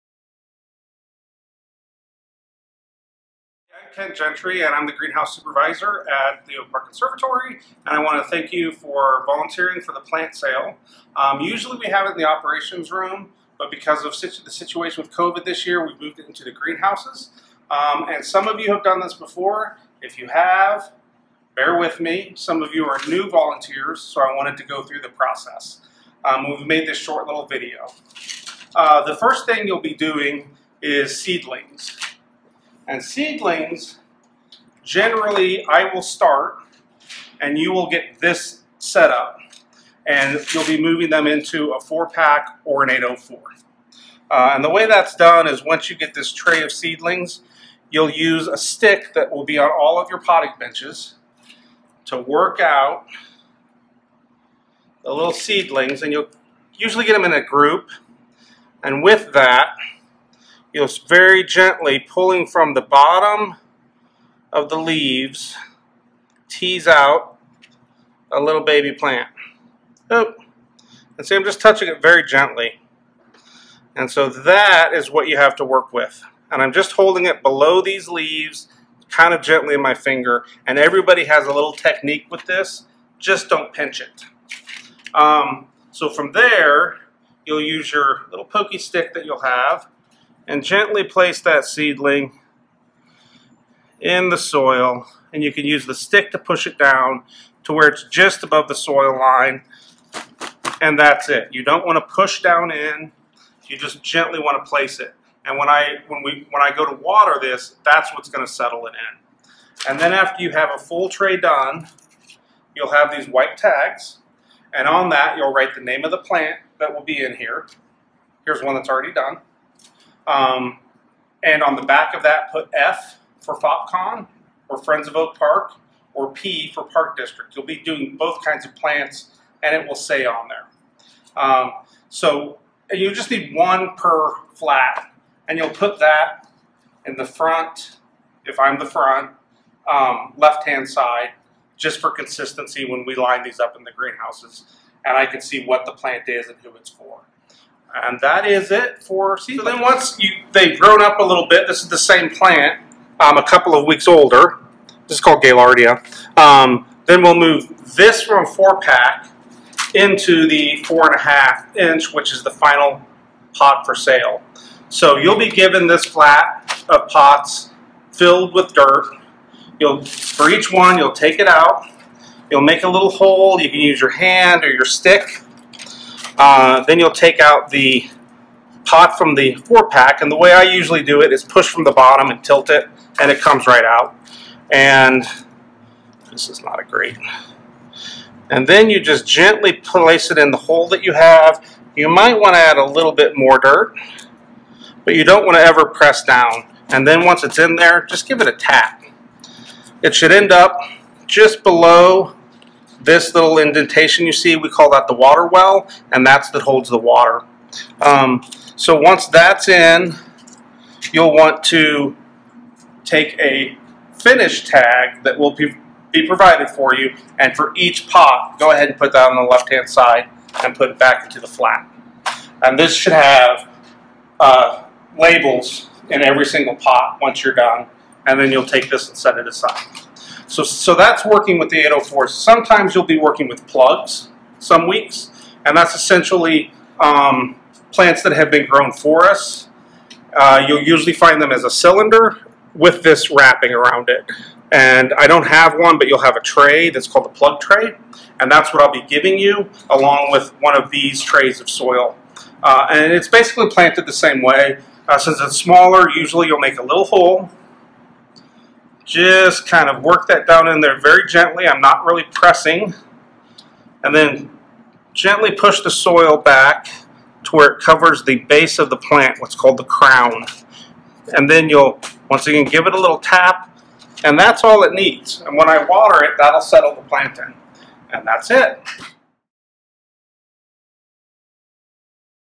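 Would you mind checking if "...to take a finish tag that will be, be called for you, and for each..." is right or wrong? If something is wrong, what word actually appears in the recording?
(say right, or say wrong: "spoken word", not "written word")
wrong: "provided", not "called".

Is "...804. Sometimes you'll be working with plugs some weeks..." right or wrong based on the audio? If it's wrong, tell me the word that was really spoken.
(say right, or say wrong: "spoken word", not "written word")
right.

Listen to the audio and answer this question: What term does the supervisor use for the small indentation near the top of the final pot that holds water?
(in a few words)
water well.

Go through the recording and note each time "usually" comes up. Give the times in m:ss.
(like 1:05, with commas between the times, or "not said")
0:11, 0:56, 3:00, 4:00, 4:16.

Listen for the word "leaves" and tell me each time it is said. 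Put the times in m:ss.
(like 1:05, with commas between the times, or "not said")
1:04, 1:18.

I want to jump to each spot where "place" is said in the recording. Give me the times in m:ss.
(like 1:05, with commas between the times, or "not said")
1:31, 1:44, 3:09.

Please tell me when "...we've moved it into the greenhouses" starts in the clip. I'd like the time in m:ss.
0:15.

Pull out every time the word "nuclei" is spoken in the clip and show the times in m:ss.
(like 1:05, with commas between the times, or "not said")
not said.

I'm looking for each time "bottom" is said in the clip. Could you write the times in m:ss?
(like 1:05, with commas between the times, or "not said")
1:02, 3:01.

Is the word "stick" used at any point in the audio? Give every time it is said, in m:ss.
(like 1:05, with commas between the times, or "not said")
0:48, 1:28, 1:35, 2:54.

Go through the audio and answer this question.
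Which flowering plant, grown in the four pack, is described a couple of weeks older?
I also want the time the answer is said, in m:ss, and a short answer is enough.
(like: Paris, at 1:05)
Gaillardia, at 2:35.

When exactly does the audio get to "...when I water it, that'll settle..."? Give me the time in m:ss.
4:35.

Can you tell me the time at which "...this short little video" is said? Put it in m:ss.
0:26.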